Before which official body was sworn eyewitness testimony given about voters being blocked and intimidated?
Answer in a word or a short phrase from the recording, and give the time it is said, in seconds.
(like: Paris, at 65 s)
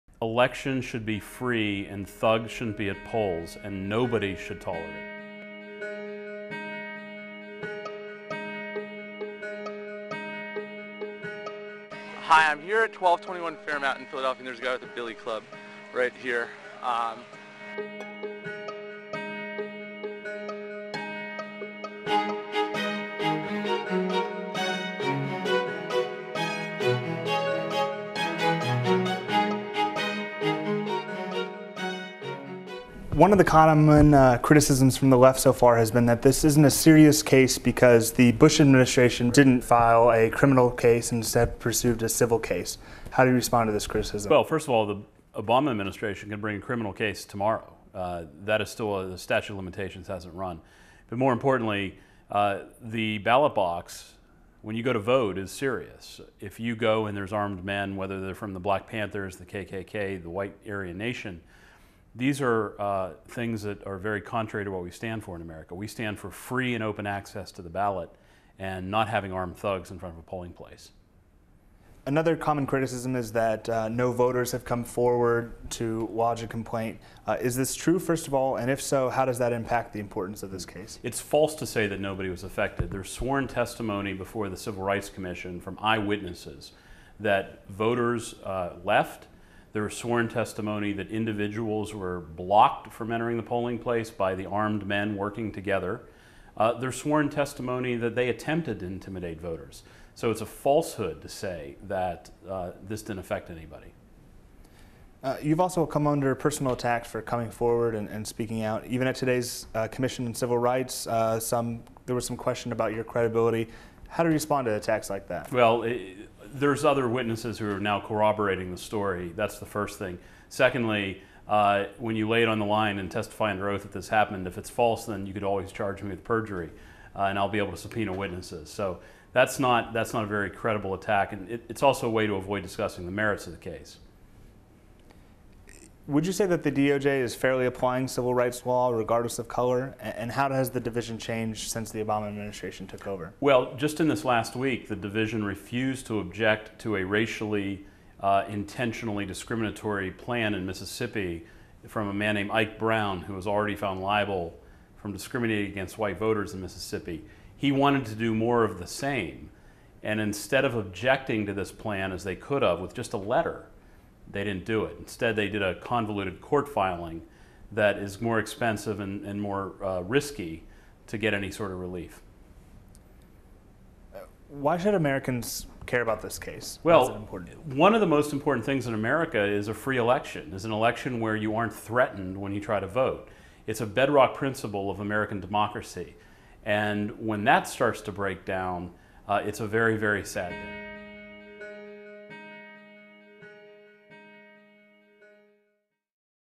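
Civil Rights Commission, at 84 s.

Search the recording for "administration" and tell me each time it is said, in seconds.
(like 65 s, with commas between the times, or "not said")
38 s, 45 s, 142 s.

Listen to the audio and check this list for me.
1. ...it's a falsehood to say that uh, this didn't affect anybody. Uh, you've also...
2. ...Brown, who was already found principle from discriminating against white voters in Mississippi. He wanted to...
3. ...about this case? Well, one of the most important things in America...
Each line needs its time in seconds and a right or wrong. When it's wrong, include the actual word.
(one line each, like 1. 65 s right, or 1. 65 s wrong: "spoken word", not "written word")
1. 100 s right
2. 152 s wrong: "liable", not "principle"
3. 176 s right.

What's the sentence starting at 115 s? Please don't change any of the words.
Well, it, there's other witnesses who are now corroborating the story.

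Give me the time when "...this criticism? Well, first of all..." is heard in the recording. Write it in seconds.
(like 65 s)
43 s.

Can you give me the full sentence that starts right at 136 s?
Would you say that the DOJ is fairly applying civil rights law regardless of color?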